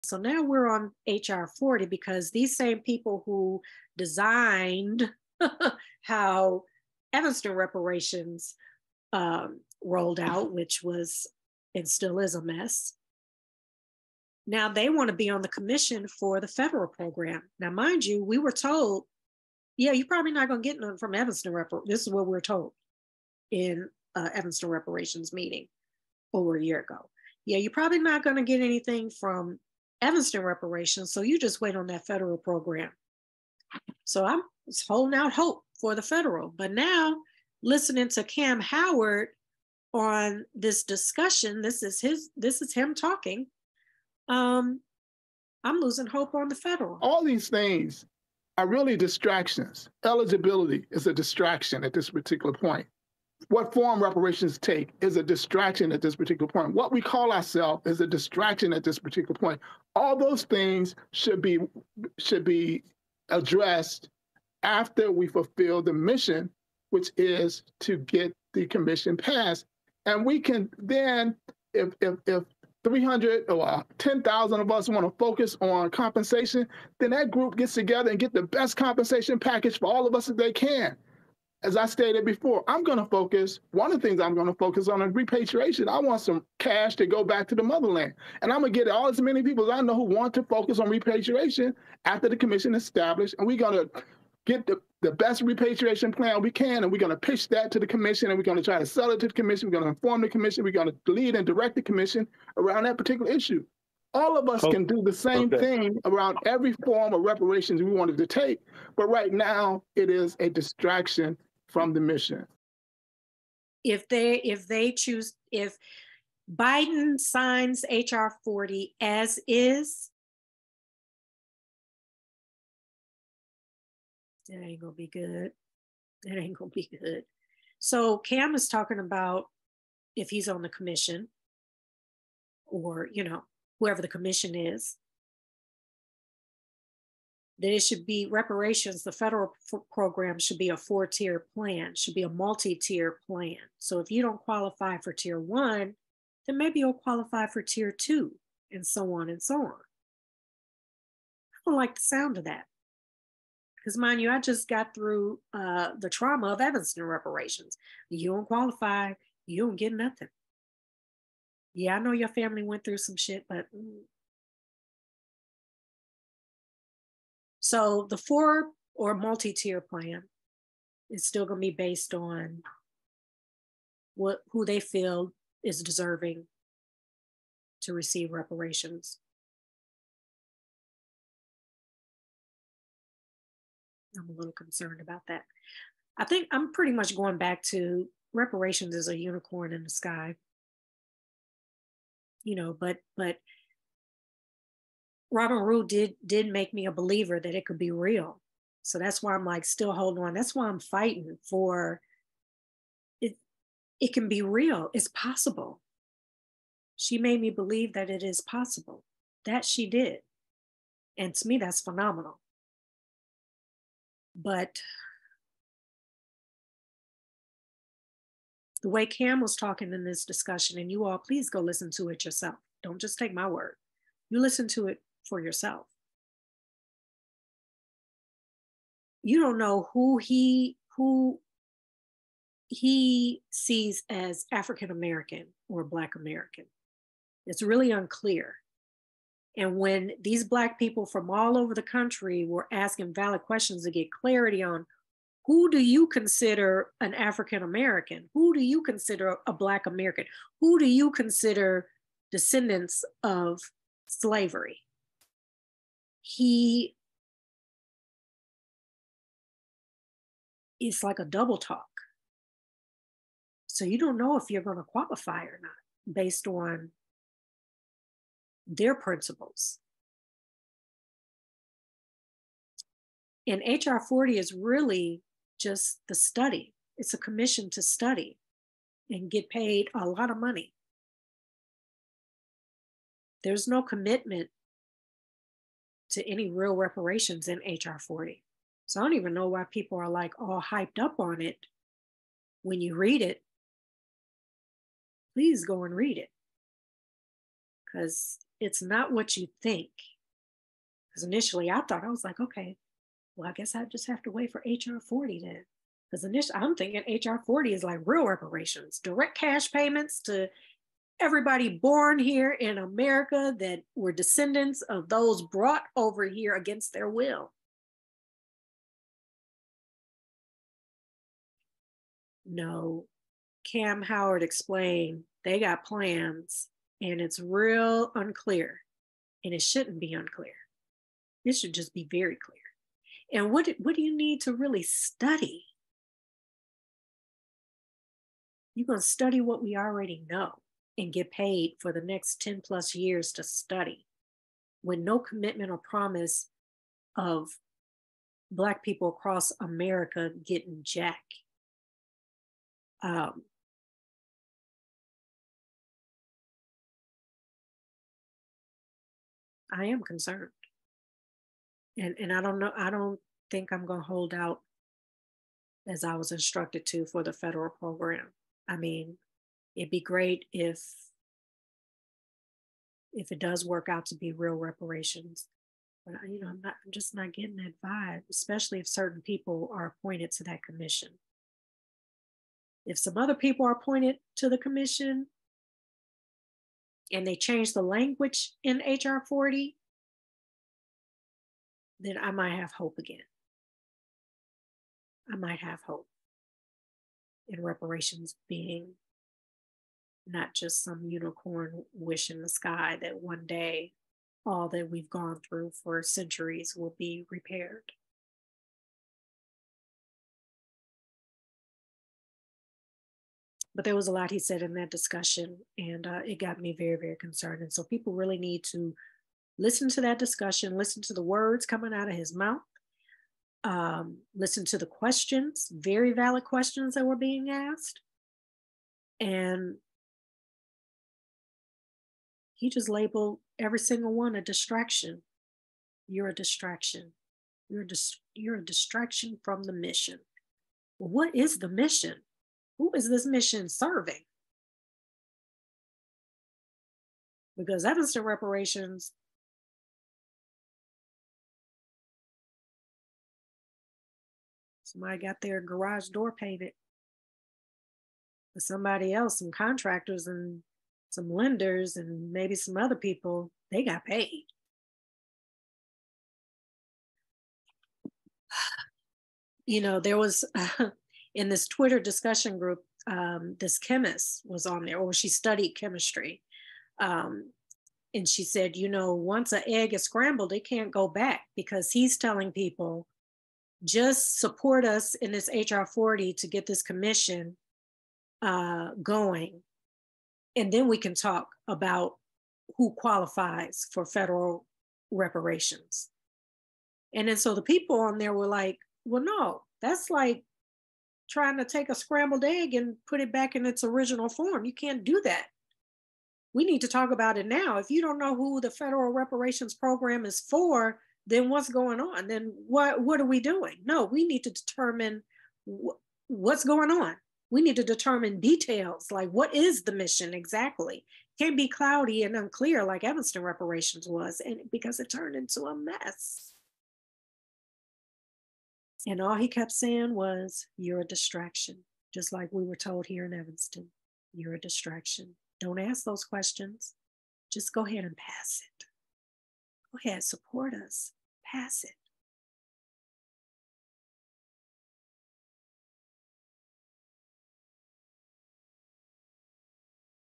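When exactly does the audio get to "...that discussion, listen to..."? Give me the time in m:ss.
7:00.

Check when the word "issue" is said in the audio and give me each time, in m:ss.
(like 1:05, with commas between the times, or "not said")
1:43.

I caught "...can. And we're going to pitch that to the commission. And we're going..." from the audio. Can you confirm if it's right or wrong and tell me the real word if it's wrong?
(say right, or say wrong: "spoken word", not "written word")
right.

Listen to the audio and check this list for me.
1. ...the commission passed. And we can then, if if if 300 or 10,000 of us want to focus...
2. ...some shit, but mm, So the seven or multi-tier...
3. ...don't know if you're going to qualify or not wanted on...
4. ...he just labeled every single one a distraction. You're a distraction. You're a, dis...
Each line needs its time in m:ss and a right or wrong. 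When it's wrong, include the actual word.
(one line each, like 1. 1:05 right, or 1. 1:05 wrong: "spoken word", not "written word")
1. 1:08 right
2. 2:42 wrong: "four", not "seven"
3. 4:23 wrong: "based", not "wanted"
4. 7:12 right.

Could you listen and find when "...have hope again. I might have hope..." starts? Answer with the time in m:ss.
6:32.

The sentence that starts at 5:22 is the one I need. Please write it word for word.
No, Kamm Howard explained they got plans and it's real unclear and it shouldn't be unclear.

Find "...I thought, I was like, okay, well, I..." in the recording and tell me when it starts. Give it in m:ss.
5:01.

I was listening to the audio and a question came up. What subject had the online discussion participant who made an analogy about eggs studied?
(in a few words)
Chemistry.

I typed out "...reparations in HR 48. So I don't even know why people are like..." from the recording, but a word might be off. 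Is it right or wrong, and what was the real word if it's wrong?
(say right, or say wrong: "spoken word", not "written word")
wrong: "40", not "48".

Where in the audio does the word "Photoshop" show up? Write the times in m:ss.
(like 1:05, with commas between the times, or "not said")
not said.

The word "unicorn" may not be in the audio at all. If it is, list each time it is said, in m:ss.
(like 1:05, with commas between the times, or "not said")
3:09, 6:41.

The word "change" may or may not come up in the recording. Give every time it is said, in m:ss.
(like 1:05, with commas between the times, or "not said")
6:27.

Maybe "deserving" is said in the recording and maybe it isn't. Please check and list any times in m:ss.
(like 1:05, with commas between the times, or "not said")
2:55.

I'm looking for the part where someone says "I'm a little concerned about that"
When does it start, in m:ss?
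3:04.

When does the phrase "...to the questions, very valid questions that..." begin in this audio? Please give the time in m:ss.
7:04.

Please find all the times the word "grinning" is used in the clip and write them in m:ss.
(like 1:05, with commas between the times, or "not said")
not said.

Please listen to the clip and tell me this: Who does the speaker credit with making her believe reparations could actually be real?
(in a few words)
Robin Rue.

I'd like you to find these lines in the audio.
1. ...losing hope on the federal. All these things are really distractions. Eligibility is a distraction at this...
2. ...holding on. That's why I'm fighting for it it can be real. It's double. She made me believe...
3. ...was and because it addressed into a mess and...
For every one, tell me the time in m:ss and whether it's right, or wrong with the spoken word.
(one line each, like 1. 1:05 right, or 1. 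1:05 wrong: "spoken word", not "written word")
1. 0:45 right
2. 3:19 wrong: "possible", not "double"
3. 8:44 wrong: "turned", not "addressed".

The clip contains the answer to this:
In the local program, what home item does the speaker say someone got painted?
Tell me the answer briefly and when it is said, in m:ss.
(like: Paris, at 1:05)
Garage door, at 7:35.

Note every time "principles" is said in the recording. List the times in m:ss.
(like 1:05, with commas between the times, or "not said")
4:28.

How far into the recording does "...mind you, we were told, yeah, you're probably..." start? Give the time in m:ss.
0:17.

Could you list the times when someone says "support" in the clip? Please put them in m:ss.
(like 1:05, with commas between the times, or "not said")
8:04, 9:00.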